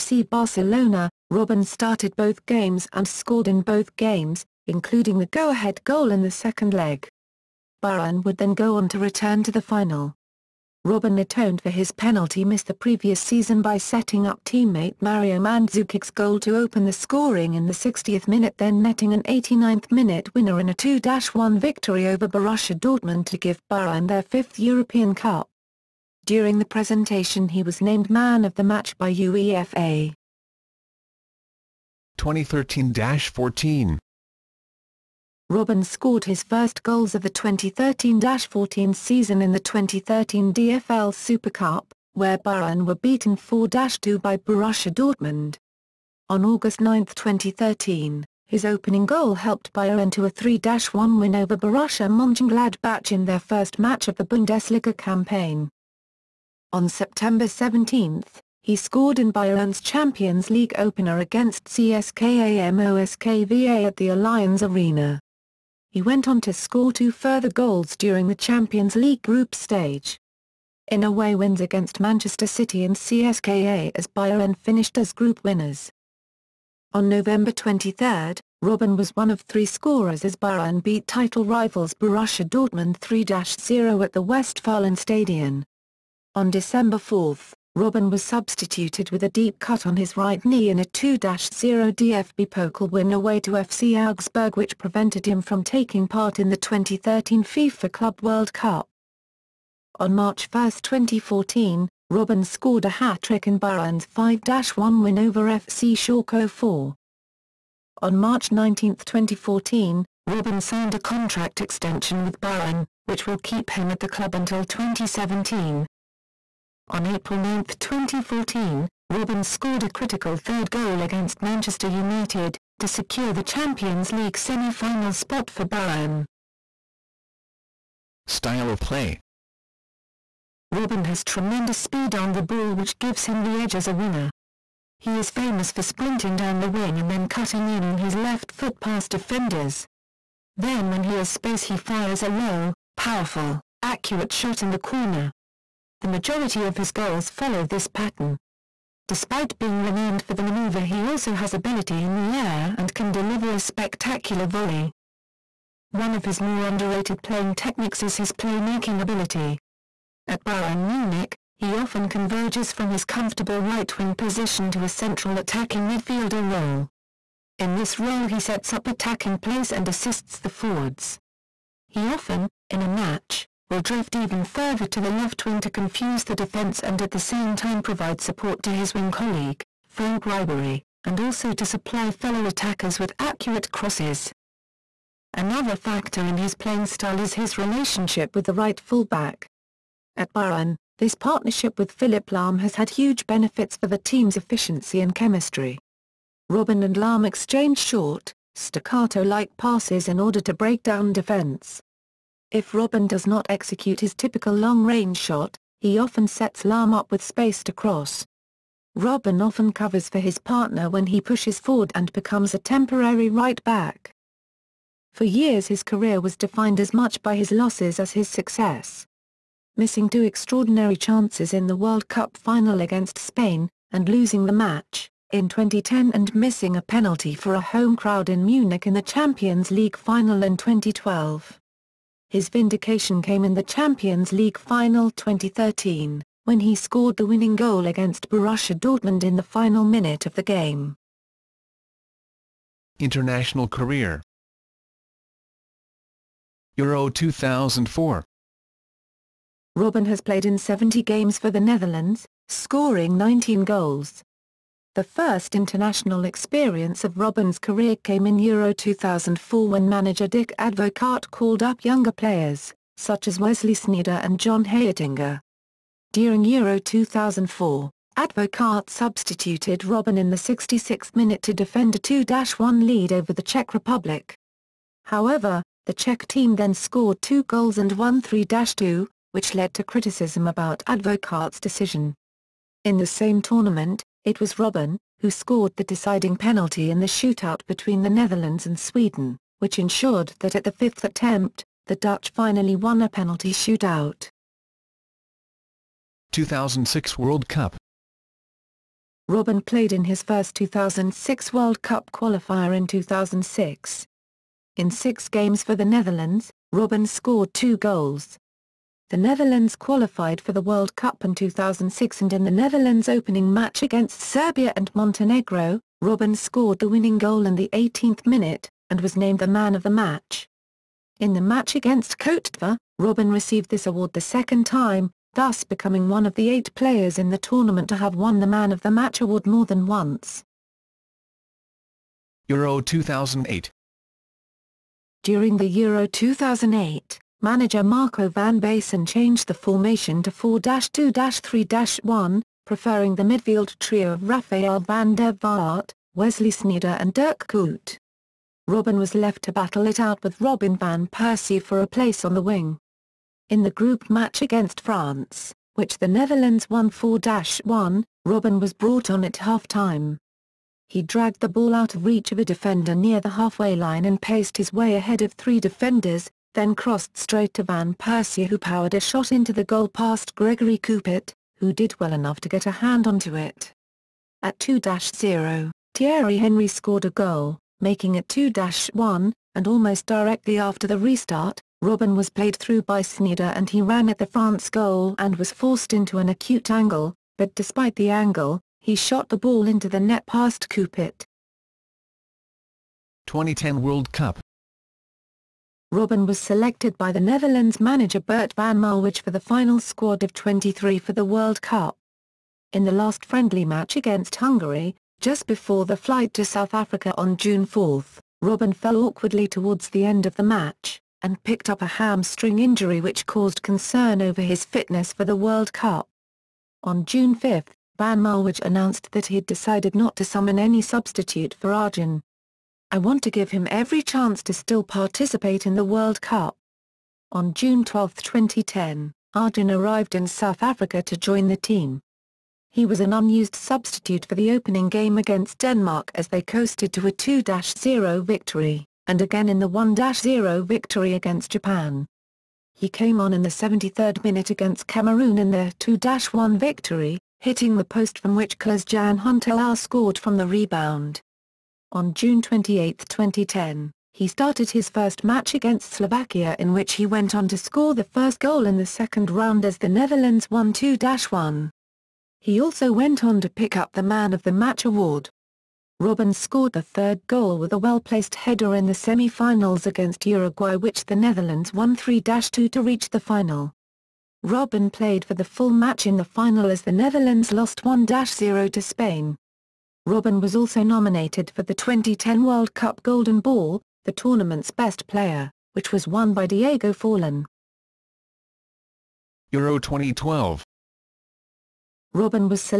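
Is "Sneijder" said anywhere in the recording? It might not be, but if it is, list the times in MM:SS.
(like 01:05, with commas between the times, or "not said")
04:23, 05:46, 06:23.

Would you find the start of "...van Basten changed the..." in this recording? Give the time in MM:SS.
05:38.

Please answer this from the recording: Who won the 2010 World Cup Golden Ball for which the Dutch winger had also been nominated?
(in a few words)
Diego Forlan.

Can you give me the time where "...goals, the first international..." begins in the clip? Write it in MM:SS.
04:13.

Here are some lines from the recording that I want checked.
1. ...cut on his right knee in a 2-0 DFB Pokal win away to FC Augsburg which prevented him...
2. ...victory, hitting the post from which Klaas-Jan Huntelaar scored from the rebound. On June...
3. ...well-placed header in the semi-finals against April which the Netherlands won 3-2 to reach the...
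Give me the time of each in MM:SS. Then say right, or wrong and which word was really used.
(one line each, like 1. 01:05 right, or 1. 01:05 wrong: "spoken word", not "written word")
1. 01:29 right
2. 07:26 right
3. 07:47 wrong: "Uruguay", not "April".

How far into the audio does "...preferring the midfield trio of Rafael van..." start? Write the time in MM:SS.
05:42.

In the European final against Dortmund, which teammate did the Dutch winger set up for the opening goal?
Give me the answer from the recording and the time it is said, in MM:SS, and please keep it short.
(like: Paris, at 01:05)
Mario Mandzukic, at 00:14.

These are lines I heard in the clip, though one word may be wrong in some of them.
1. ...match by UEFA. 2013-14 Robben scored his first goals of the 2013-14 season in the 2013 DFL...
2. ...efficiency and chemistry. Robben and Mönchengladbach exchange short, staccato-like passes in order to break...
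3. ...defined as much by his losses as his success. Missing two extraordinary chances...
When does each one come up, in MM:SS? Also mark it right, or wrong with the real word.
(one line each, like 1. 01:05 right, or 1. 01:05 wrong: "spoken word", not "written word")
1. 00:28 right
2. 03:14 wrong: "Lahm", not "Mönchengladbach"
3. 03:36 right.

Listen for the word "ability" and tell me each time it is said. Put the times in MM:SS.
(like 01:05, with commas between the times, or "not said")
02:31, 02:38.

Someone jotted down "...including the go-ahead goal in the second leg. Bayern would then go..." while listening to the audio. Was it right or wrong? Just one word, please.
right.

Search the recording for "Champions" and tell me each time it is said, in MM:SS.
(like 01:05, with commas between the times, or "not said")
00:59, 01:08, 02:03, 03:49, 03:53.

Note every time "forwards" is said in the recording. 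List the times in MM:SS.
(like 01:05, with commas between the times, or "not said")
02:50, 03:31.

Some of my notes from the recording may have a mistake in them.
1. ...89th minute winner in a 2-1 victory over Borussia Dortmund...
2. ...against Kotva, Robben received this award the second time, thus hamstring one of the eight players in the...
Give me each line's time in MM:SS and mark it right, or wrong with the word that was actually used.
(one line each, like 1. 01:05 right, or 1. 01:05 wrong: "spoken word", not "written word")
1. 00:19 right
2. 05:21 wrong: "becoming", not "hamstring".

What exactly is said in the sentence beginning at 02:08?
Style of play Robben has tremendous speed on the ball which gives him the edge as a winger.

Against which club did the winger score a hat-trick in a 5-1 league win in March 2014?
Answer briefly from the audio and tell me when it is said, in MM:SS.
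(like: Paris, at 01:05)
FC Schalke 04, at 01:45.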